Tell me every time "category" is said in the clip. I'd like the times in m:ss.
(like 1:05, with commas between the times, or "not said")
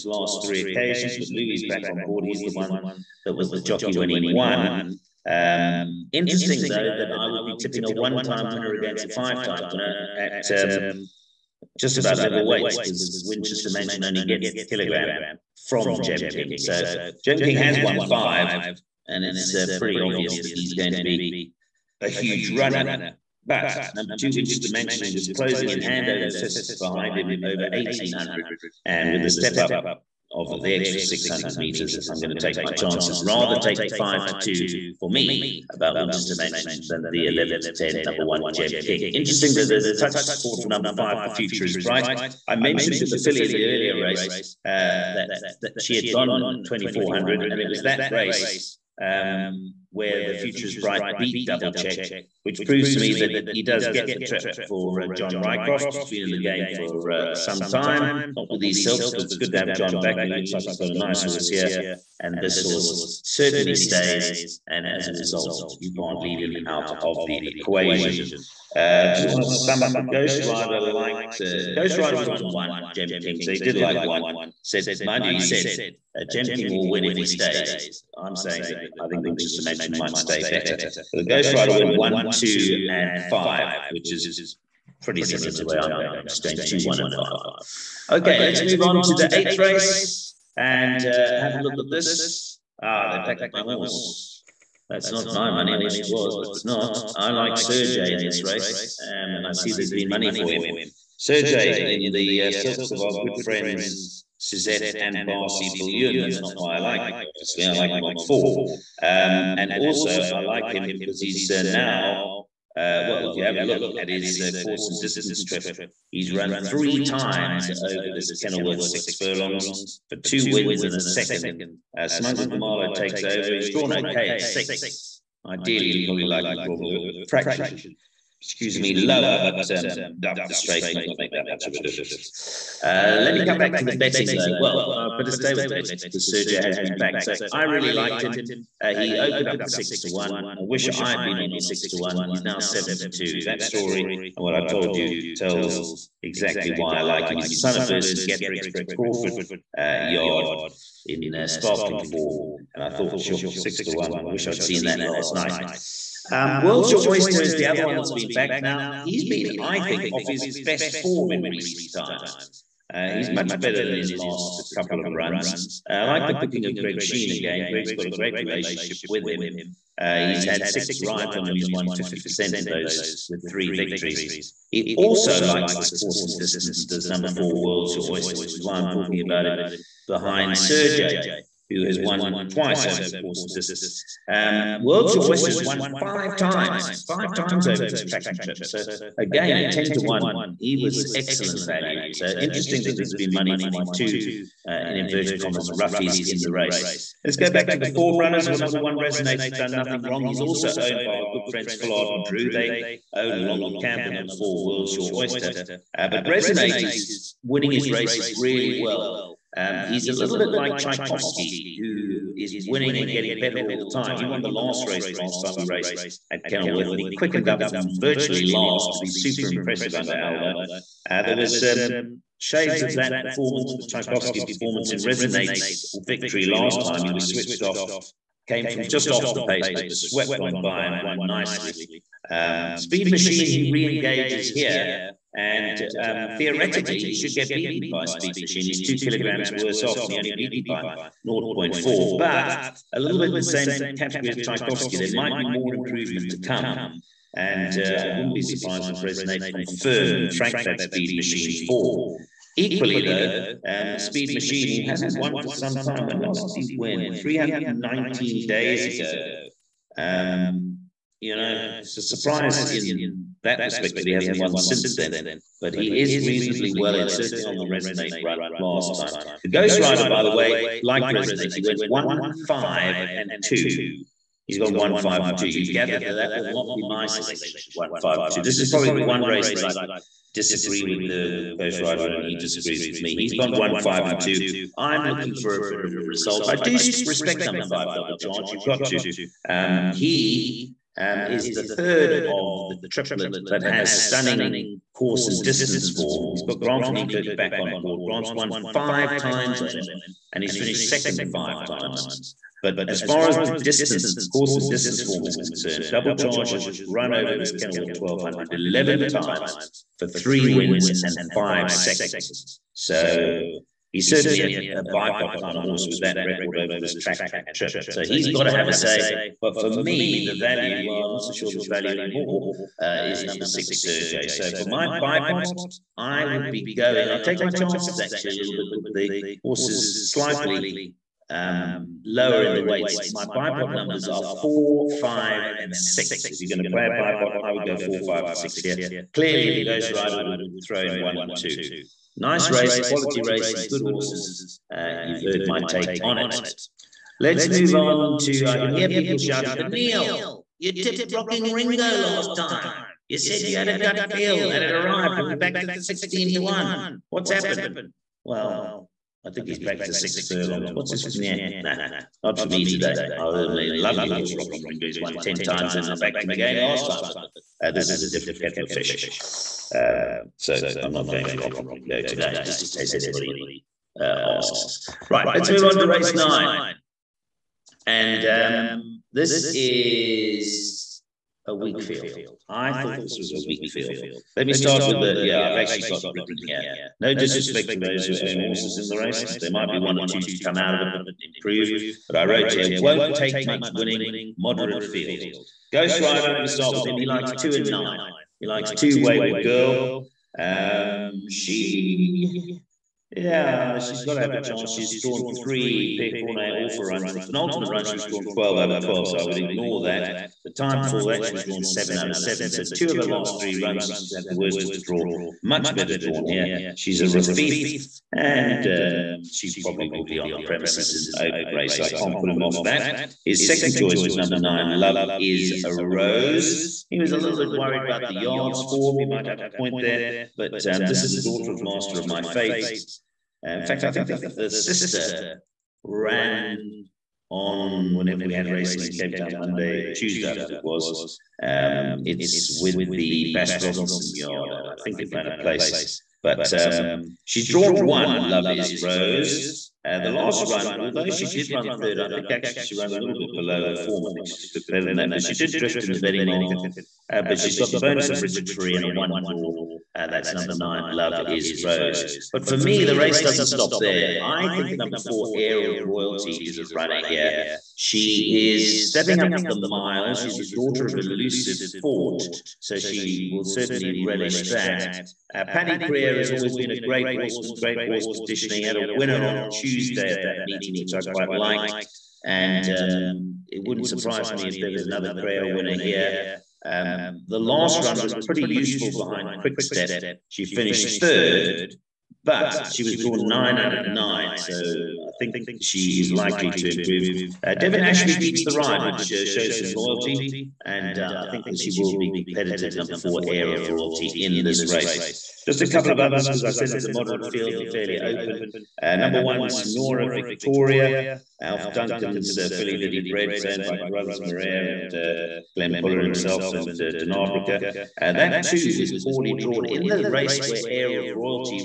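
4:03.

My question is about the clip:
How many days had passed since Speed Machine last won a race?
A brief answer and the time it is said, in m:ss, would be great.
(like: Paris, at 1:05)
319, at 4:17.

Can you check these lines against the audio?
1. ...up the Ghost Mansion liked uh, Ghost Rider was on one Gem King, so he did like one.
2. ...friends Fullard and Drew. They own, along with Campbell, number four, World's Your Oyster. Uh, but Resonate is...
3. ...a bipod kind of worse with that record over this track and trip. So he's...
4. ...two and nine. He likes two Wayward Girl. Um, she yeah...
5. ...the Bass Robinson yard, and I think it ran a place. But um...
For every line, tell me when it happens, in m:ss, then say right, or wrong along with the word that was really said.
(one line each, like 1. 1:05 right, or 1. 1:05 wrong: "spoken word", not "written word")
1. 1:09 wrong: "Rider", not "Mansion"
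2. 3:21 right
3. 5:14 wrong: "horse", not "worse"
4. 6:37 right
5. 7:22 right.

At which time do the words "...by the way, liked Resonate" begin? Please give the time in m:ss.
4:30.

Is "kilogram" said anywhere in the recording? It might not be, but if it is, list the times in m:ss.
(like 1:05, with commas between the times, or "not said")
0:14, 3:58.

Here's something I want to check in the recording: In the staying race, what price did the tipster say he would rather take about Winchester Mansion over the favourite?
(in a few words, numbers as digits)
5 to 2.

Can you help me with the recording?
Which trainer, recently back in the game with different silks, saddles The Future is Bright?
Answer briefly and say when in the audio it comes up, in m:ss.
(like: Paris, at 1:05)
John Rycroft, at 0:55.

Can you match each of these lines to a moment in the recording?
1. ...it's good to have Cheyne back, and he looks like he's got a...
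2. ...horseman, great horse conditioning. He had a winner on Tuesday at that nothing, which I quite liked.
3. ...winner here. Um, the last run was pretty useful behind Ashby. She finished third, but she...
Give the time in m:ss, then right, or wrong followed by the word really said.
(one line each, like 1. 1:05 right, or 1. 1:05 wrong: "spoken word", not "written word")
1. 0:59 wrong: "John", not "Cheyne"
2. 7:57 wrong: "meeting", not "nothing"
3. 8:05 wrong: "Quickstep", not "Ashby".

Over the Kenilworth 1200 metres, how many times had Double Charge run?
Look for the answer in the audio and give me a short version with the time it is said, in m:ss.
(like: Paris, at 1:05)
11, at 5:08.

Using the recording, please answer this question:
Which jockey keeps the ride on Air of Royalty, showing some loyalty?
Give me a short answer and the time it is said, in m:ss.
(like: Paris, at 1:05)
Devon Ashby, at 8:17.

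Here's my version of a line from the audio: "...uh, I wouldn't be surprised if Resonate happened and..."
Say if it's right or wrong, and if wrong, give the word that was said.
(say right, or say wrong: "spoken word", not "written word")
wrong: "confirmed", not "happened".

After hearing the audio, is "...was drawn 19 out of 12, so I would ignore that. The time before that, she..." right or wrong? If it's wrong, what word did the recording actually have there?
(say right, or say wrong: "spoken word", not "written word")
wrong: "12", not "19".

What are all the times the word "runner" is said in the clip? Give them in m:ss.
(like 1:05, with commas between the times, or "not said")
0:22, 3:18, 7:46.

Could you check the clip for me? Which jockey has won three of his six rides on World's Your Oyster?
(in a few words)
Greg Cheyne.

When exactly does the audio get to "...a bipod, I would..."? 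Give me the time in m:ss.
5:36.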